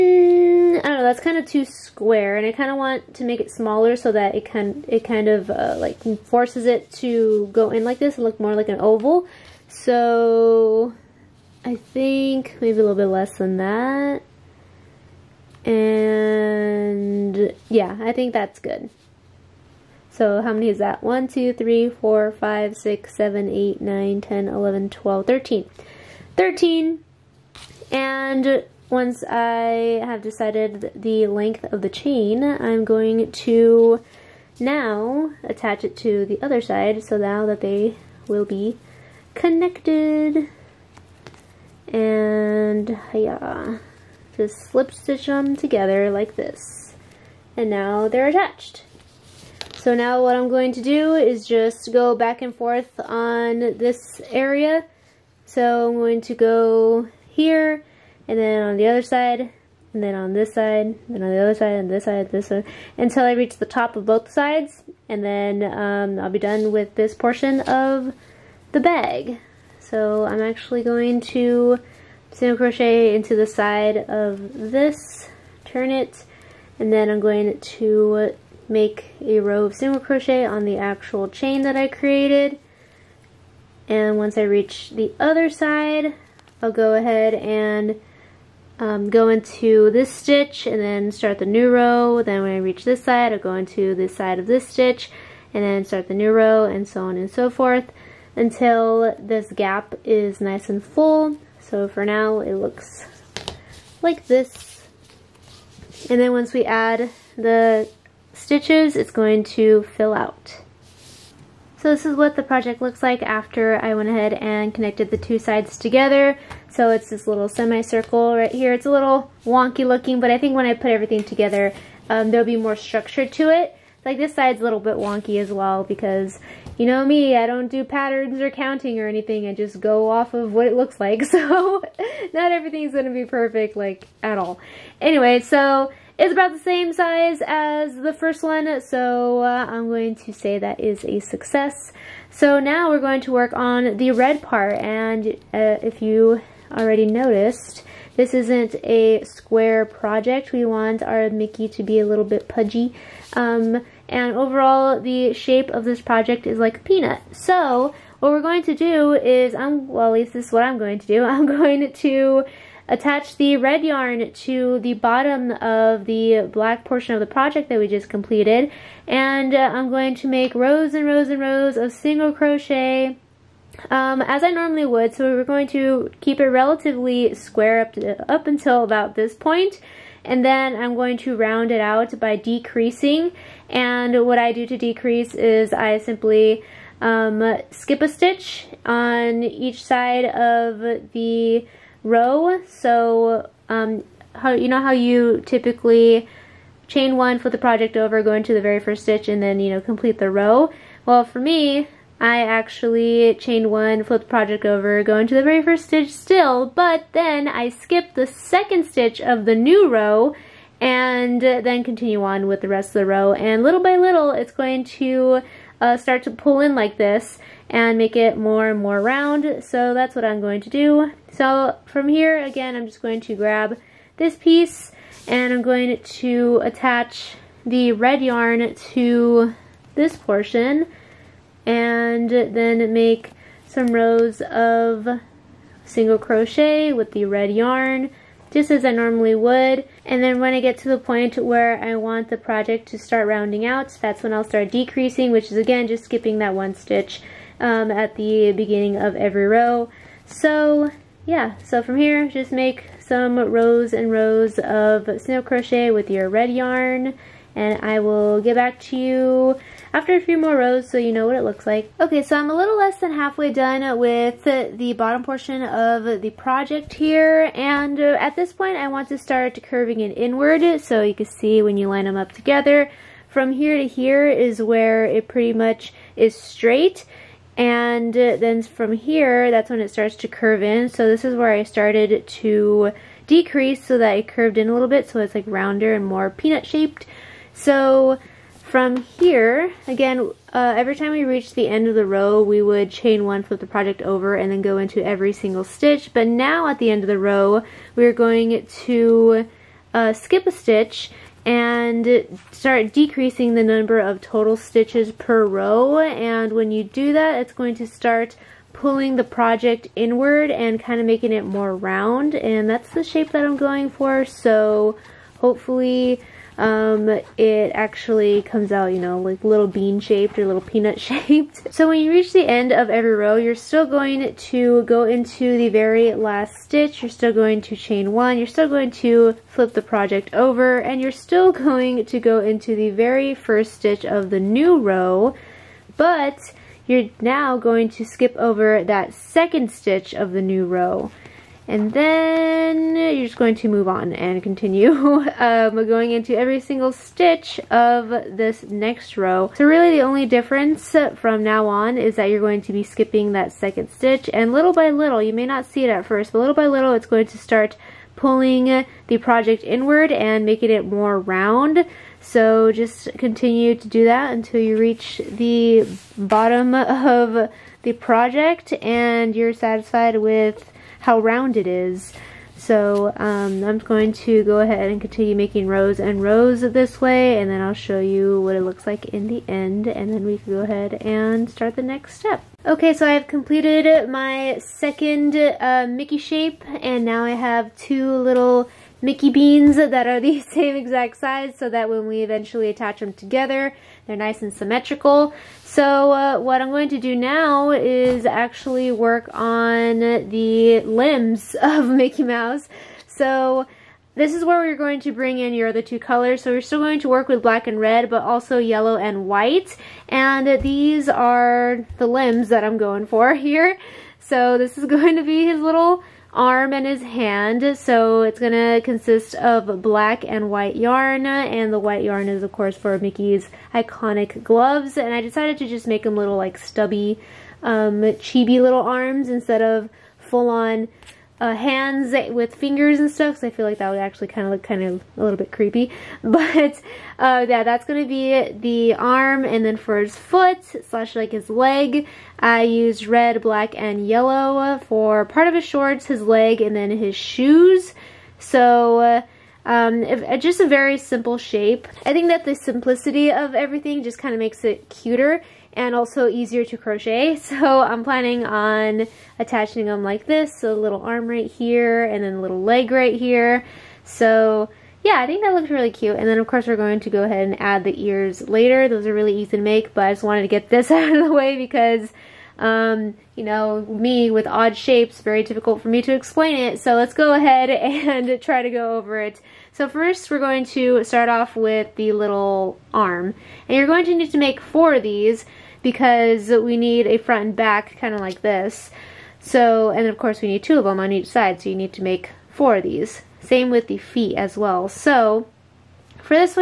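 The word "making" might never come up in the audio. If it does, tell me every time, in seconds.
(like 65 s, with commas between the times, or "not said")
311 s, 360 s, 375 s.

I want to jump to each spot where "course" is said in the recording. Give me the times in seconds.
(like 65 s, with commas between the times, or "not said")
422 s, 466 s, 490 s.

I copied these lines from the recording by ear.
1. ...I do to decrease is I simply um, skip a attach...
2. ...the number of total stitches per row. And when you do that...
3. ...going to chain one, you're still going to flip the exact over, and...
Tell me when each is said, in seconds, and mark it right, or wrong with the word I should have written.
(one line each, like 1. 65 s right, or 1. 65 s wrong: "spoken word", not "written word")
1. 184 s wrong: "stitch", not "attach"
2. 303 s right
3. 327 s wrong: "project", not "exact".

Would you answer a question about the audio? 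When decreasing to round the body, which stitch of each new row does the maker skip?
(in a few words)
The second stitch.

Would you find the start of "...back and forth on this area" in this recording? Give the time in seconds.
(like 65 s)
52 s.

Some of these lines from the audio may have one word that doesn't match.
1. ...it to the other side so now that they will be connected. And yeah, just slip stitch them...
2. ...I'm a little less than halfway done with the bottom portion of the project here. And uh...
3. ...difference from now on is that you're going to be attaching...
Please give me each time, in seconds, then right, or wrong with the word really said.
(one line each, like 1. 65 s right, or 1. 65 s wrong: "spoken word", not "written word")
1. 35 s right
2. 262 s right
3. 350 s wrong: "skipping", not "attaching".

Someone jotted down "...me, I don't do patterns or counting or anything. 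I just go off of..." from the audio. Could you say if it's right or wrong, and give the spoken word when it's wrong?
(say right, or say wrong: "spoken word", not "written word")
right.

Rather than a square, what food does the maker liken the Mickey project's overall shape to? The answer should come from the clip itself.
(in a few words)
A peanut.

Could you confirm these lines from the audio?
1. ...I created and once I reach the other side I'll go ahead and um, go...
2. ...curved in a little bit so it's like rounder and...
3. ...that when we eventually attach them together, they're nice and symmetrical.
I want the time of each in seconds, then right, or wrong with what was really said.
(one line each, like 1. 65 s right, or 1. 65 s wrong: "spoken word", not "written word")
1. 81 s right
2. 284 s right
3. 391 s right.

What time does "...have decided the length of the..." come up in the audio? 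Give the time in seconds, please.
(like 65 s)
30 s.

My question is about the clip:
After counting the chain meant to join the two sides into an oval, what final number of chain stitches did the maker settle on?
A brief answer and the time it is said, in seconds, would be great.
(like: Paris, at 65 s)
13, at 25 s.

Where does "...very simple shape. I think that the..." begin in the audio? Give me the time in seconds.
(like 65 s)
450 s.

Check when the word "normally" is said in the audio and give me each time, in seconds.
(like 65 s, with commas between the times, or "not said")
174 s, 238 s.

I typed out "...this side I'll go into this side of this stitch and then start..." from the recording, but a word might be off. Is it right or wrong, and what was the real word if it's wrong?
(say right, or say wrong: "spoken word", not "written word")
right.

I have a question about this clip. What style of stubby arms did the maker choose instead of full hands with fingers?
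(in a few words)
Chibi.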